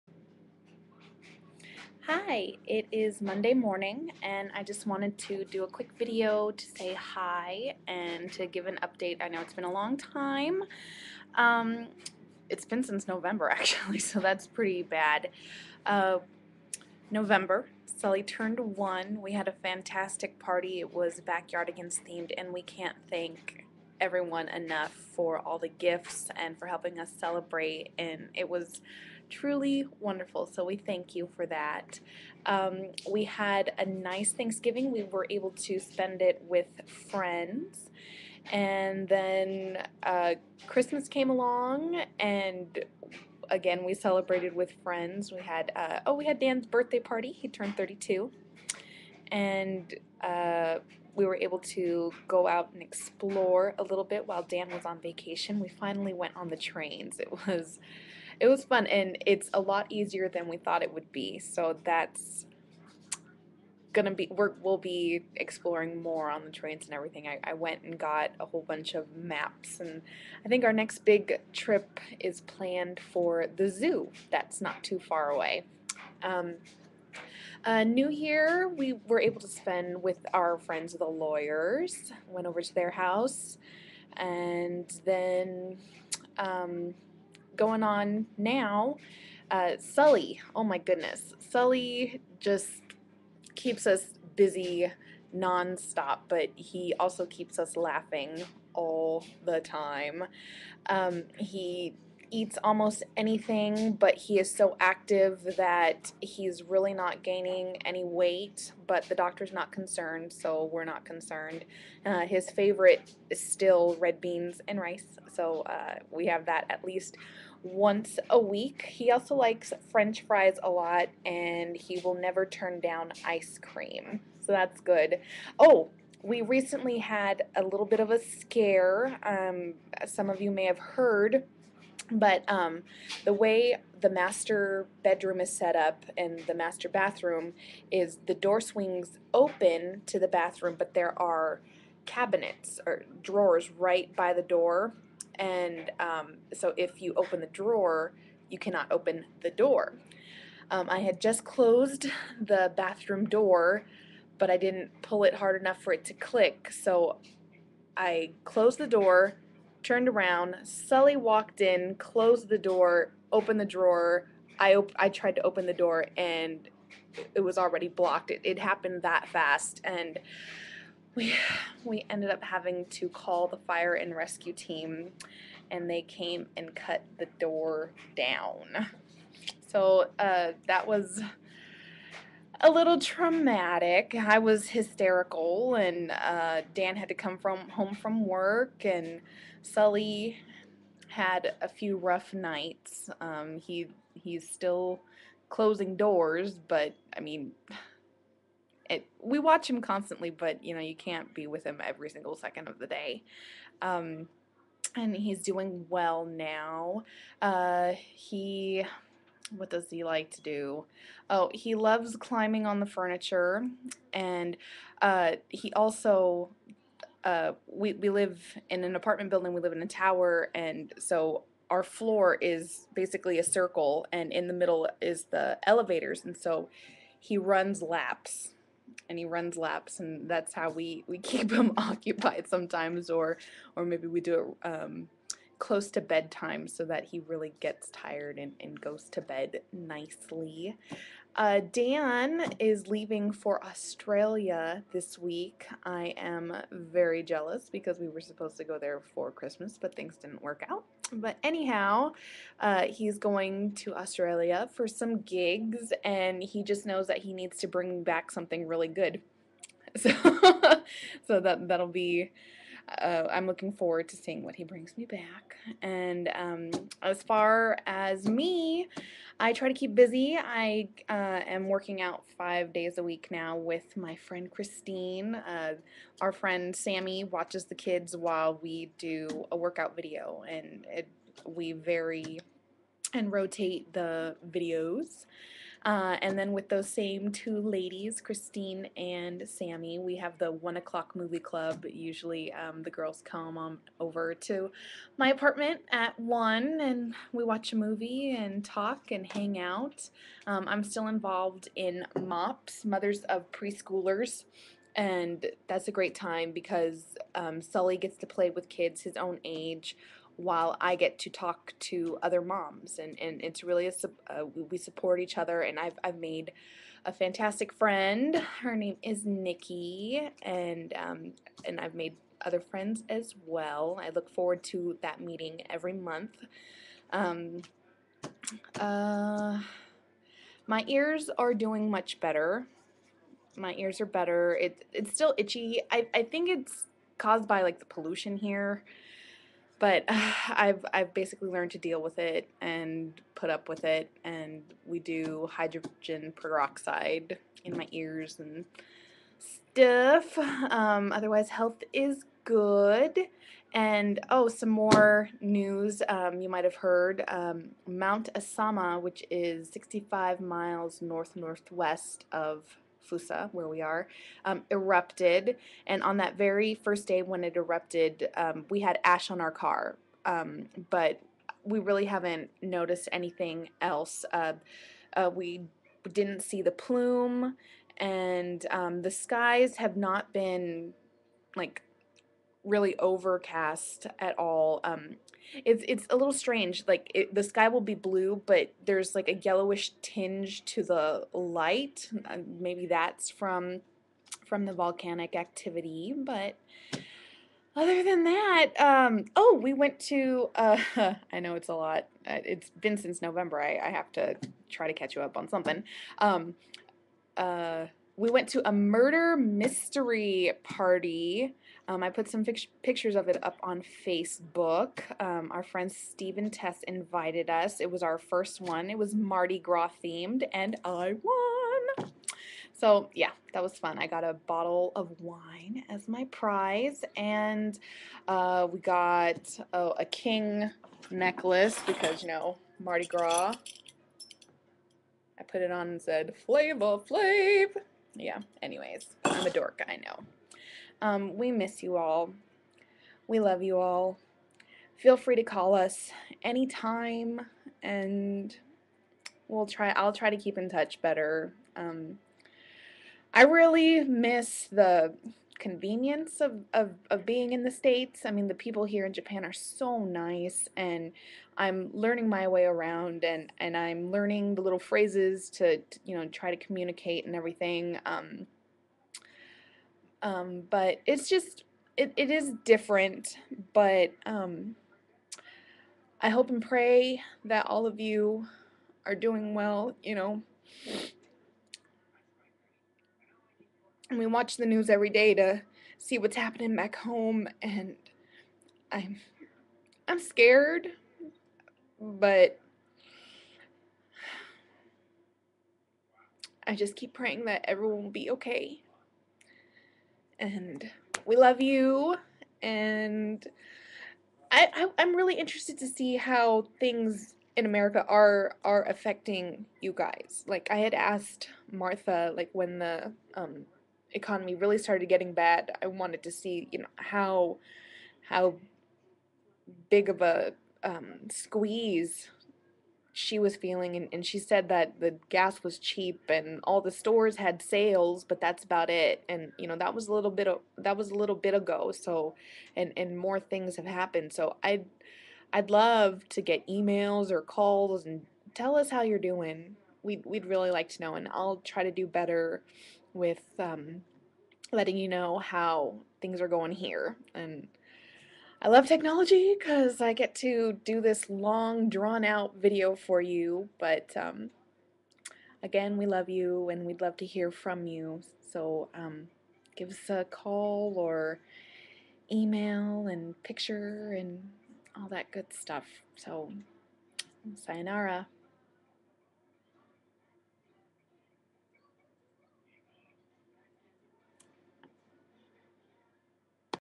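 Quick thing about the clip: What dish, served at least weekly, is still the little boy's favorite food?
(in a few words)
red beans and rice.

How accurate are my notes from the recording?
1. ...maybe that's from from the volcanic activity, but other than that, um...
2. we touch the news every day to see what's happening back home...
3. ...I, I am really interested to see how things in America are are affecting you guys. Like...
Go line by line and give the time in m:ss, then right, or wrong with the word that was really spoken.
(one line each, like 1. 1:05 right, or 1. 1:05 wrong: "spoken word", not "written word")
1. 6:32 right
2. 8:04 wrong: "watch", not "touch"
3. 8:24 right.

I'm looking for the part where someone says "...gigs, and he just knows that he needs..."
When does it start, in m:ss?
4:15.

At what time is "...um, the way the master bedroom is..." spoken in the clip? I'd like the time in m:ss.
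2:12.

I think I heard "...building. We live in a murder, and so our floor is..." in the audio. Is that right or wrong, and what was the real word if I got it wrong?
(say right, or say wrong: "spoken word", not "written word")
wrong: "tower", not "murder".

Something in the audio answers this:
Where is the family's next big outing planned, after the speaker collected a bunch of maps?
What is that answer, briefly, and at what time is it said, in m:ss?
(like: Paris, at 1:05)
the zoo, at 1:13.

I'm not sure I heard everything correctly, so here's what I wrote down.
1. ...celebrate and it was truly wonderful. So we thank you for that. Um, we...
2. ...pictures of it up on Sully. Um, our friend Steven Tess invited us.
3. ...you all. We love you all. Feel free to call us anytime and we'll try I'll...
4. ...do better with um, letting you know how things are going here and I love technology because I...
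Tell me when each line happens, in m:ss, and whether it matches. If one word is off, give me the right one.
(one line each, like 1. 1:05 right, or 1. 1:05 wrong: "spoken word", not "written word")
1. 0:27 right
2. 6:52 wrong: "Facebook", not "Sully"
3. 7:21 right
4. 9:01 right.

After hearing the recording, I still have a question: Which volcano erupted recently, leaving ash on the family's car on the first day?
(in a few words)
Mount Asama.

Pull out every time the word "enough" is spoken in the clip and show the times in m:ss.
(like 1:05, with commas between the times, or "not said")
0:24, 2:35.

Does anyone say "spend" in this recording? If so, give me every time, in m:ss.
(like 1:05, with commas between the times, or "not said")
0:35, 1:19.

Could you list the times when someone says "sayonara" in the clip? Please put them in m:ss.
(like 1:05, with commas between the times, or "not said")
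9:27.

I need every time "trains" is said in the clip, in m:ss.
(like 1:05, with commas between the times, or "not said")
0:56, 1:06.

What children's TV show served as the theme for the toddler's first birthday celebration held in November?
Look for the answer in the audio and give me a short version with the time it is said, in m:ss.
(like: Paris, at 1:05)
Backyardigans, at 0:21.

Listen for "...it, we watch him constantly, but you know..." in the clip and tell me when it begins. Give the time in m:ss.
3:18.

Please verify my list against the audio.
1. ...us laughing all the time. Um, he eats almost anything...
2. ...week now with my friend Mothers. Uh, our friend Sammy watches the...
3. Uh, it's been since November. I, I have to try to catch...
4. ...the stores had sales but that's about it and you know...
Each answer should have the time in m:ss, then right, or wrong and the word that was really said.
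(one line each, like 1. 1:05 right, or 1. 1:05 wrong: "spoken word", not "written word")
1. 1:37 right
2. 4:33 wrong: "Christine", not "Mothers"
3. 6:42 right
4. 8:46 right.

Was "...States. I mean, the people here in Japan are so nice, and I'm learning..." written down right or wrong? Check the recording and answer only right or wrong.
right.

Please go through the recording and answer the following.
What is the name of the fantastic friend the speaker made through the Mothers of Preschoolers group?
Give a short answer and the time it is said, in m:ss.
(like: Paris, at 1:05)
Nikki, at 5:19.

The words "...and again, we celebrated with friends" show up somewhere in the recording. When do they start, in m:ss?
0:42.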